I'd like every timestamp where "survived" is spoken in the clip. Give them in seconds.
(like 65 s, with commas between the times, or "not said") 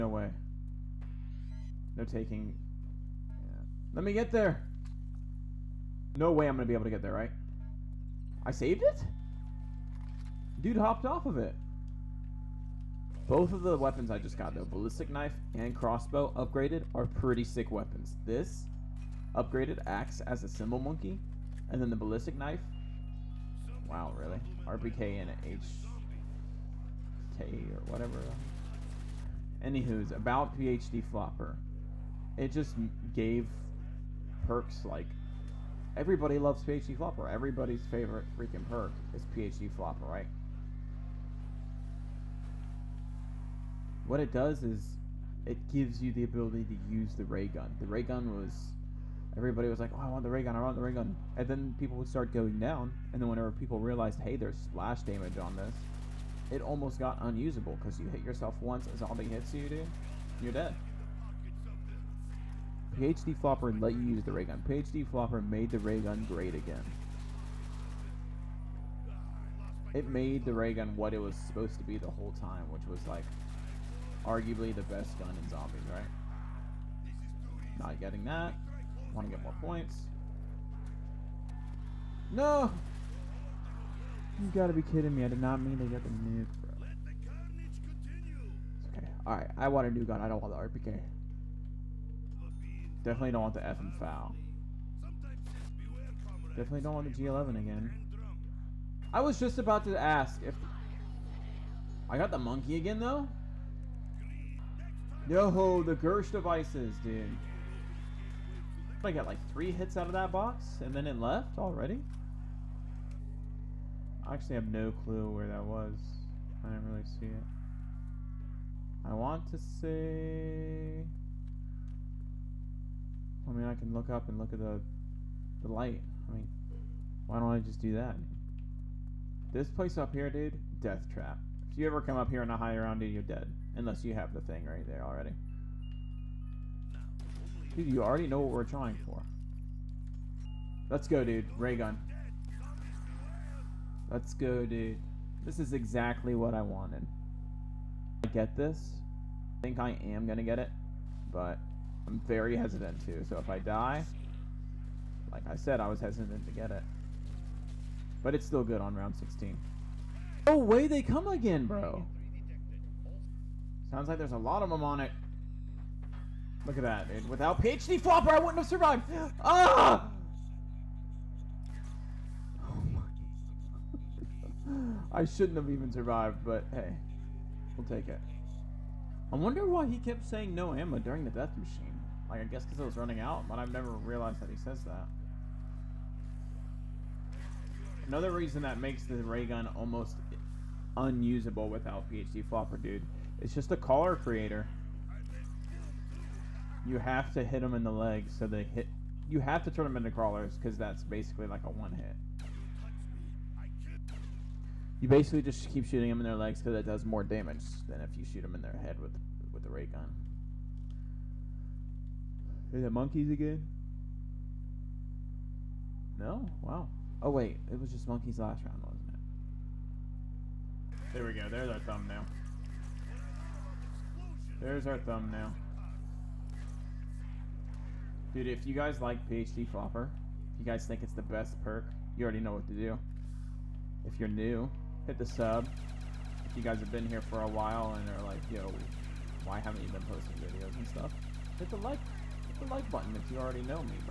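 168 s, 175 s.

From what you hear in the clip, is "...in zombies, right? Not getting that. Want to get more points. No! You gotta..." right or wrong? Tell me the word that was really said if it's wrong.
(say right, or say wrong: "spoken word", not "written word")
right.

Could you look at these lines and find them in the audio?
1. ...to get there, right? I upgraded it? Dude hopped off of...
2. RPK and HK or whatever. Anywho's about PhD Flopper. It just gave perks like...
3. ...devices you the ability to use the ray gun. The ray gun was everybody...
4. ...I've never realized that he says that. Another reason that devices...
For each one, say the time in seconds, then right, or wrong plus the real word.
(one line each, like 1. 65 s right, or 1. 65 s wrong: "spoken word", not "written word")
1. 6 s wrong: "saved", not "upgraded"
2. 24 s right
3. 45 s wrong: "gives", not "devices"
4. 183 s wrong: "makes", not "devices".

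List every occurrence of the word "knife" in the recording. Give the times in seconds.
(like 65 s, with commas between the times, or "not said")
15 s, 22 s.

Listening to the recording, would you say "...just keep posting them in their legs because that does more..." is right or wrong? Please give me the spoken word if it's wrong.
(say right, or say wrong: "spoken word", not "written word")
wrong: "shooting", not "posting".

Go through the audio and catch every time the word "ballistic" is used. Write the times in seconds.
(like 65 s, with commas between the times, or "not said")
14 s, 21 s.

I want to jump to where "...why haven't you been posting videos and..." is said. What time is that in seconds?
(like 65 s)
239 s.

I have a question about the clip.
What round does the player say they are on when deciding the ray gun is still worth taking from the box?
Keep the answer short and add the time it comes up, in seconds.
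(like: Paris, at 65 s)
16, at 158 s.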